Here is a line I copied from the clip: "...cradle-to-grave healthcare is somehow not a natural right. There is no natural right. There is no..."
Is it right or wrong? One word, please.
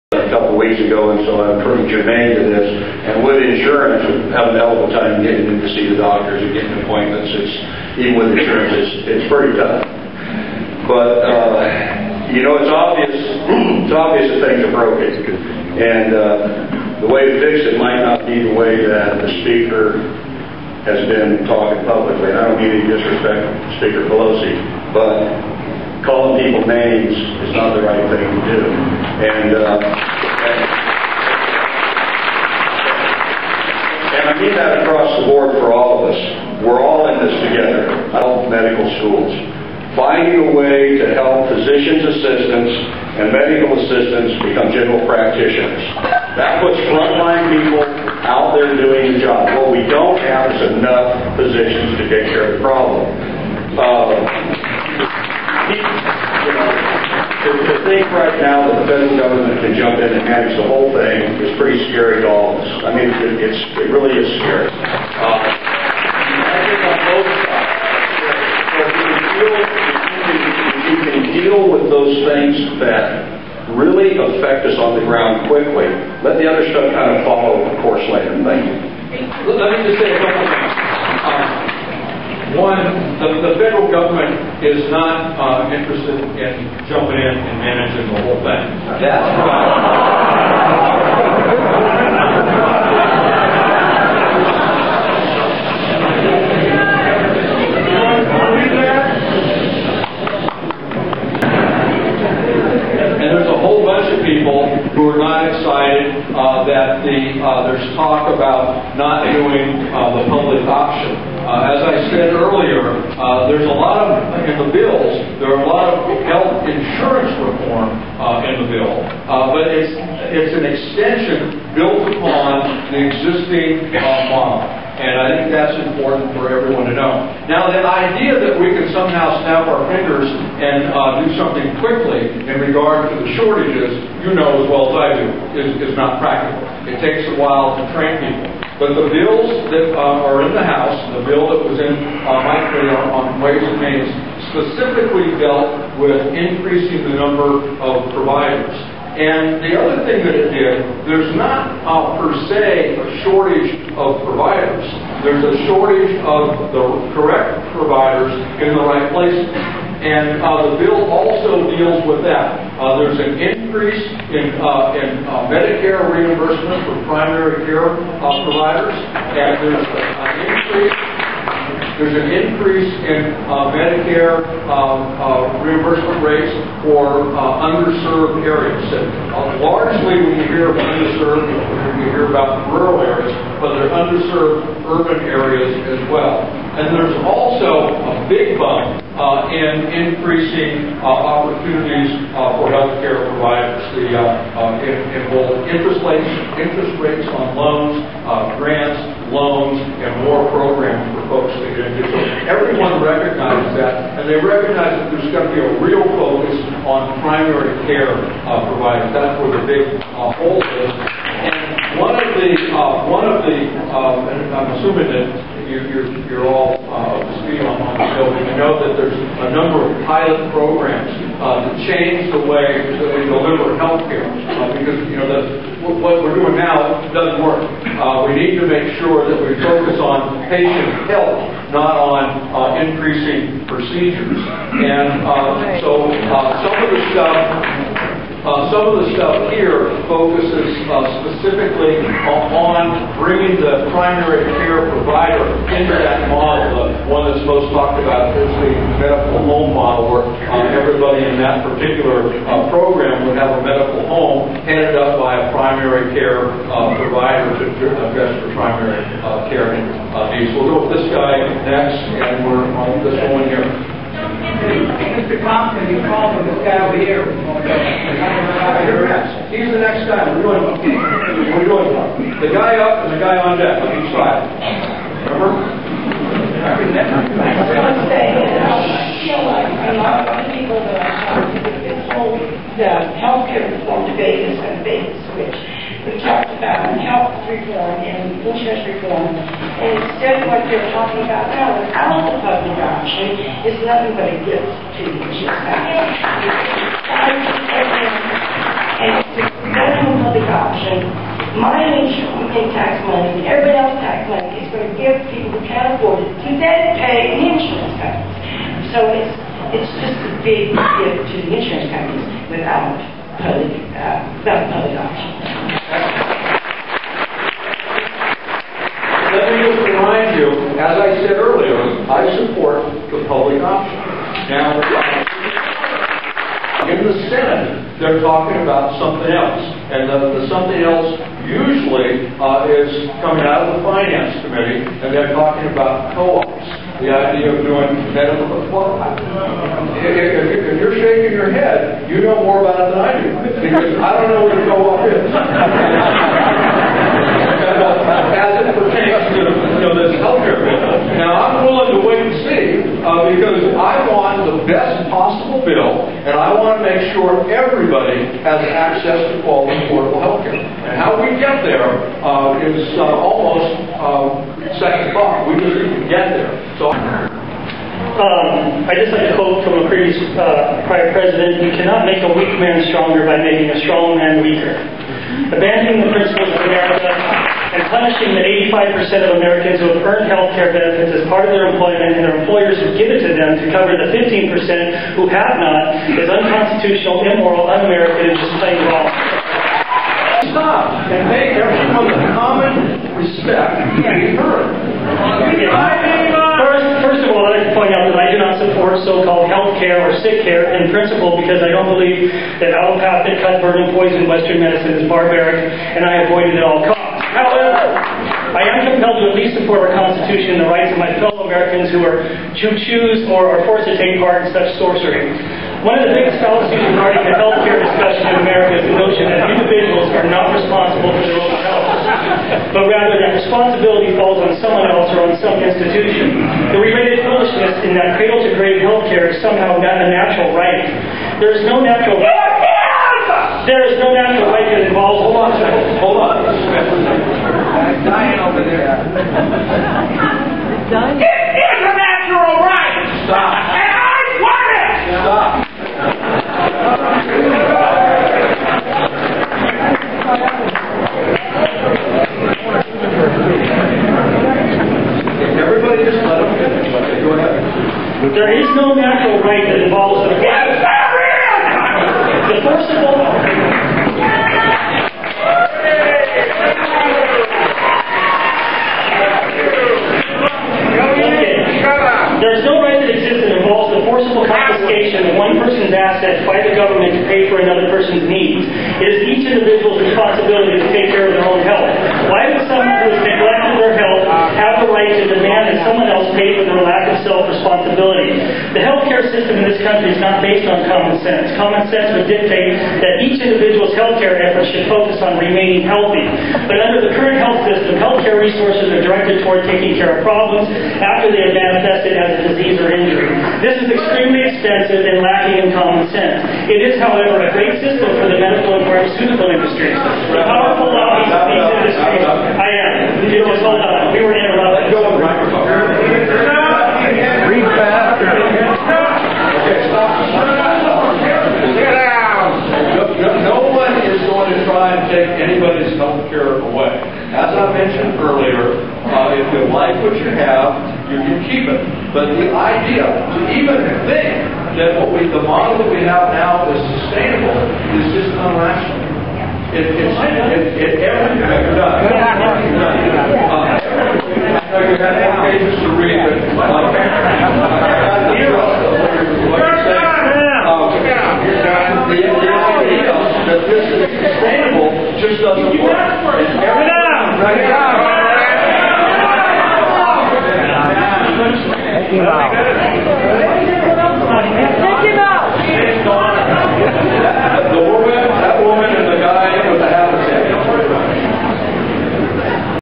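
right.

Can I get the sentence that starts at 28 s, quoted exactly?
And, uh, and, and I mean that across the board for all of us.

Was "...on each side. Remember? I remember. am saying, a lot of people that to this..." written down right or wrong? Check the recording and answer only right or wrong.
right.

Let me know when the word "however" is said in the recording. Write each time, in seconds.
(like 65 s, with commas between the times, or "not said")
506 s.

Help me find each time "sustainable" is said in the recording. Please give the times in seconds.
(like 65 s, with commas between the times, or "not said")
536 s, 554 s.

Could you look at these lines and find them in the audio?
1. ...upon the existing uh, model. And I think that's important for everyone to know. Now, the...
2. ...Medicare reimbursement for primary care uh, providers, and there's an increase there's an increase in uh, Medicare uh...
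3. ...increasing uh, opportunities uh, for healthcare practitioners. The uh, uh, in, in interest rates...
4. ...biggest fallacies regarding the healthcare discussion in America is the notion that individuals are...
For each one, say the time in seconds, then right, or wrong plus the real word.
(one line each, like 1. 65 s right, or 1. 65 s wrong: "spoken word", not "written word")
1. 122 s right
2. 165 s right
3. 189 s wrong: "providers", not "practitioners"
4. 416 s right.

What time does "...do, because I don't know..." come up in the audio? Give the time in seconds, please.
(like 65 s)
343 s.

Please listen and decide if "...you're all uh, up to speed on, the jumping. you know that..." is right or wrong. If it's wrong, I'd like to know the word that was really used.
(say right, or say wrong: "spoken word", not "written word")
wrong: "building", not "jumping".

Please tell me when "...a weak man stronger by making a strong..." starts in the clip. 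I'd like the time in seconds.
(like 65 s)
372 s.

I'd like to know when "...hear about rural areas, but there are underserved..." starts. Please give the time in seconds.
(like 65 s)
182 s.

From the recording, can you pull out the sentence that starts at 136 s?
It takes a while to train people.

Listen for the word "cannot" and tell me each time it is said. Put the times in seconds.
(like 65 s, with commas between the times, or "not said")
371 s.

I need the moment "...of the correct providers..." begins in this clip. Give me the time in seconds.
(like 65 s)
156 s.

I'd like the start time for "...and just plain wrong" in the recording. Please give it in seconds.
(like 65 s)
388 s.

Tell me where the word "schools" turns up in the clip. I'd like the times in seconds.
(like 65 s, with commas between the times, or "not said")
39 s.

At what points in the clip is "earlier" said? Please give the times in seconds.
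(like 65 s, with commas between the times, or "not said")
112 s, 321 s.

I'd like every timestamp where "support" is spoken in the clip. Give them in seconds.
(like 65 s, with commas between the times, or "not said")
322 s, 398 s, 409 s.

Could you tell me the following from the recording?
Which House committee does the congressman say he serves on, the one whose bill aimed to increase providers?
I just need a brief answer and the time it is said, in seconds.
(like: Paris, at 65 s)
Ways and Means, at 143 s.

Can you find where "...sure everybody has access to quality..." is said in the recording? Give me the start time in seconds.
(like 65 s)
357 s.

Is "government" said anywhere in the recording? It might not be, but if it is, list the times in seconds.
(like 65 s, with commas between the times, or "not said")
59 s, 83 s.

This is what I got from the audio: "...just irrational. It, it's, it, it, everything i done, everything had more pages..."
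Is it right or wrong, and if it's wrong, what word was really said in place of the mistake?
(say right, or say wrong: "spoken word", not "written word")
right.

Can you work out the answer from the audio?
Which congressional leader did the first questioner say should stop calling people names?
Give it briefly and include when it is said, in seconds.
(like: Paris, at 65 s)
Speaker Pelosi, at 23 s.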